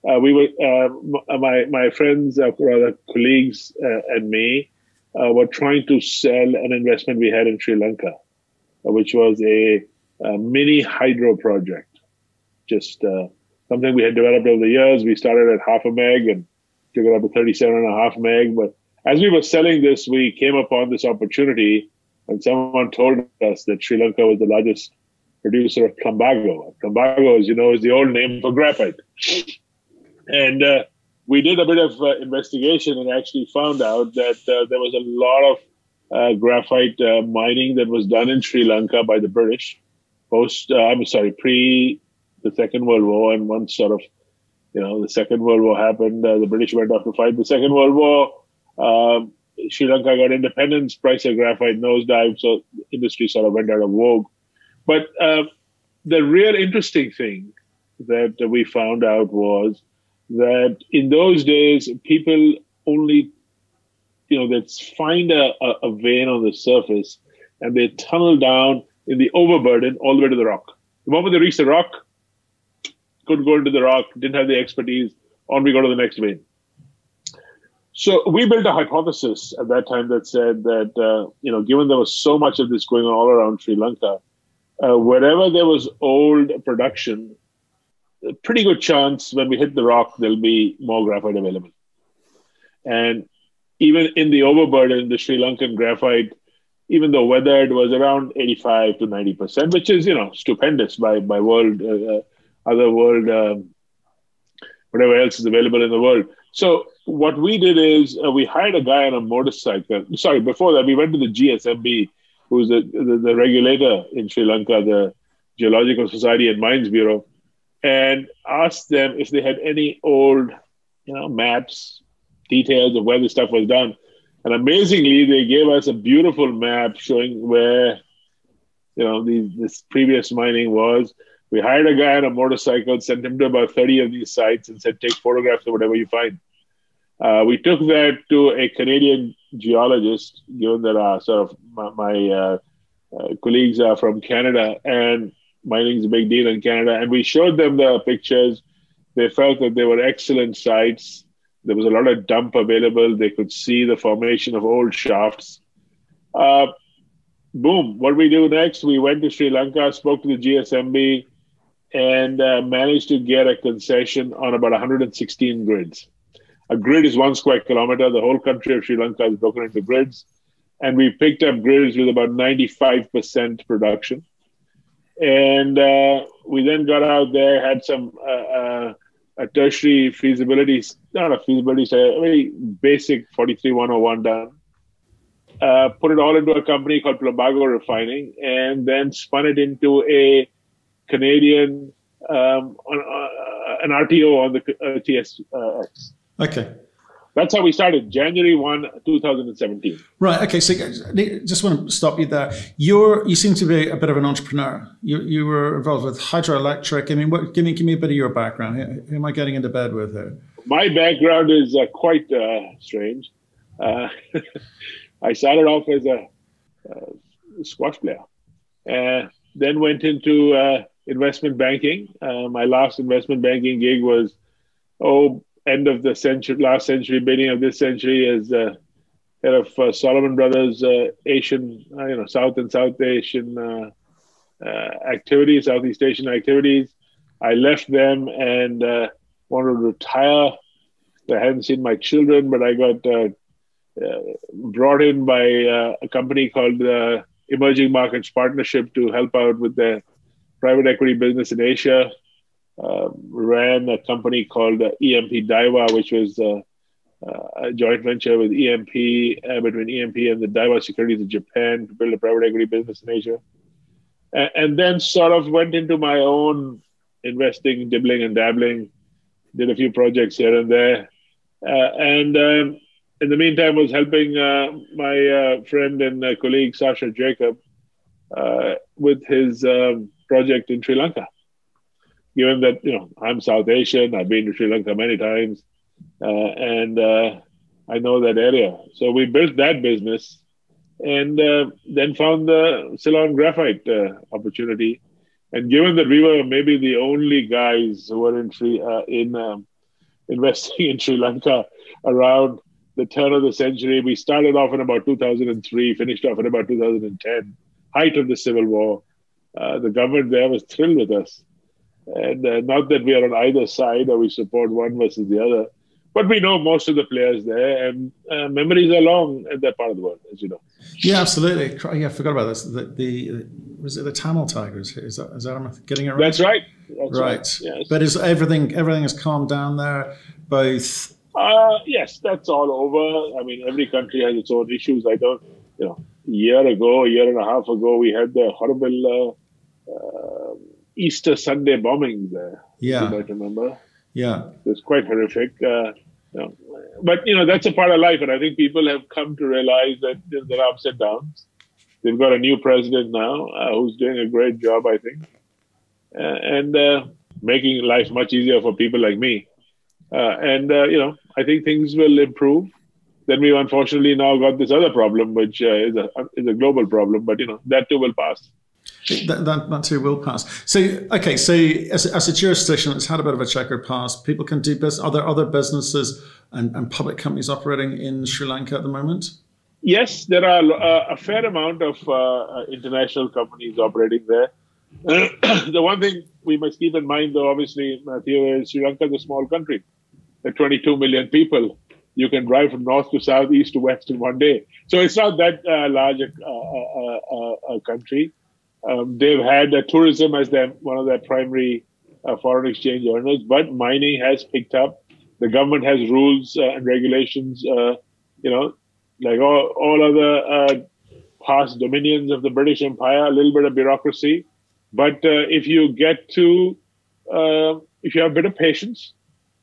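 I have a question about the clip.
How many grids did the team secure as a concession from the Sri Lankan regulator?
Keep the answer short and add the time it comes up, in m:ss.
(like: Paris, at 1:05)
116, at 2:44.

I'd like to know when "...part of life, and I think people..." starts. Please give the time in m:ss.
5:47.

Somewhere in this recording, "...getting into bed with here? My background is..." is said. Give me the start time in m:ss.
3:29.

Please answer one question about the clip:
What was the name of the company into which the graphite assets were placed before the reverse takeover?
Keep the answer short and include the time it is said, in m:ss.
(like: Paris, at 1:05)
Plumbago Refining, at 3:07.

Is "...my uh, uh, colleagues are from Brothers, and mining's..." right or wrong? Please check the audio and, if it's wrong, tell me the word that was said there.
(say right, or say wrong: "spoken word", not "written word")
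wrong: "Canada", not "Brothers".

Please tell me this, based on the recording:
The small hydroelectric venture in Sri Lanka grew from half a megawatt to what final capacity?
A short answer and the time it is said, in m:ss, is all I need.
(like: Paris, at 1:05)
37.5 MW, at 0:17.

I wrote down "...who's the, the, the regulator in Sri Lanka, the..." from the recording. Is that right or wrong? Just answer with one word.
right.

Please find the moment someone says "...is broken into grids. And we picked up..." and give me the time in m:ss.
2:49.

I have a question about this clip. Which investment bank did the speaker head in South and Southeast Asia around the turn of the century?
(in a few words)
Salomon Brothers.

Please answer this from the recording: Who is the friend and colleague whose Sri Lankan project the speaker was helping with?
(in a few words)
Sasha Jacob.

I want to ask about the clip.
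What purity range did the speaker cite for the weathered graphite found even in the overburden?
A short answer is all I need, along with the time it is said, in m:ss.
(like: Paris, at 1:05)
85 to 90%, at 1:38.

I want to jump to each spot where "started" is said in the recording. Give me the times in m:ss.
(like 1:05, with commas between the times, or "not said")
0:15, 3:17, 3:35, 5:04.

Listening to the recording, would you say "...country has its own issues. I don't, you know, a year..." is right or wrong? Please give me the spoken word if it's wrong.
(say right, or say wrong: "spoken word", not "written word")
right.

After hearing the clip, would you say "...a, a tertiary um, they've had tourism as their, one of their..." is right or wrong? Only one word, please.
wrong.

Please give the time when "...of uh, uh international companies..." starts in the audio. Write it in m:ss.
6:21.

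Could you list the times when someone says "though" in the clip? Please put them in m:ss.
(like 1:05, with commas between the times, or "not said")
1:37, 6:27.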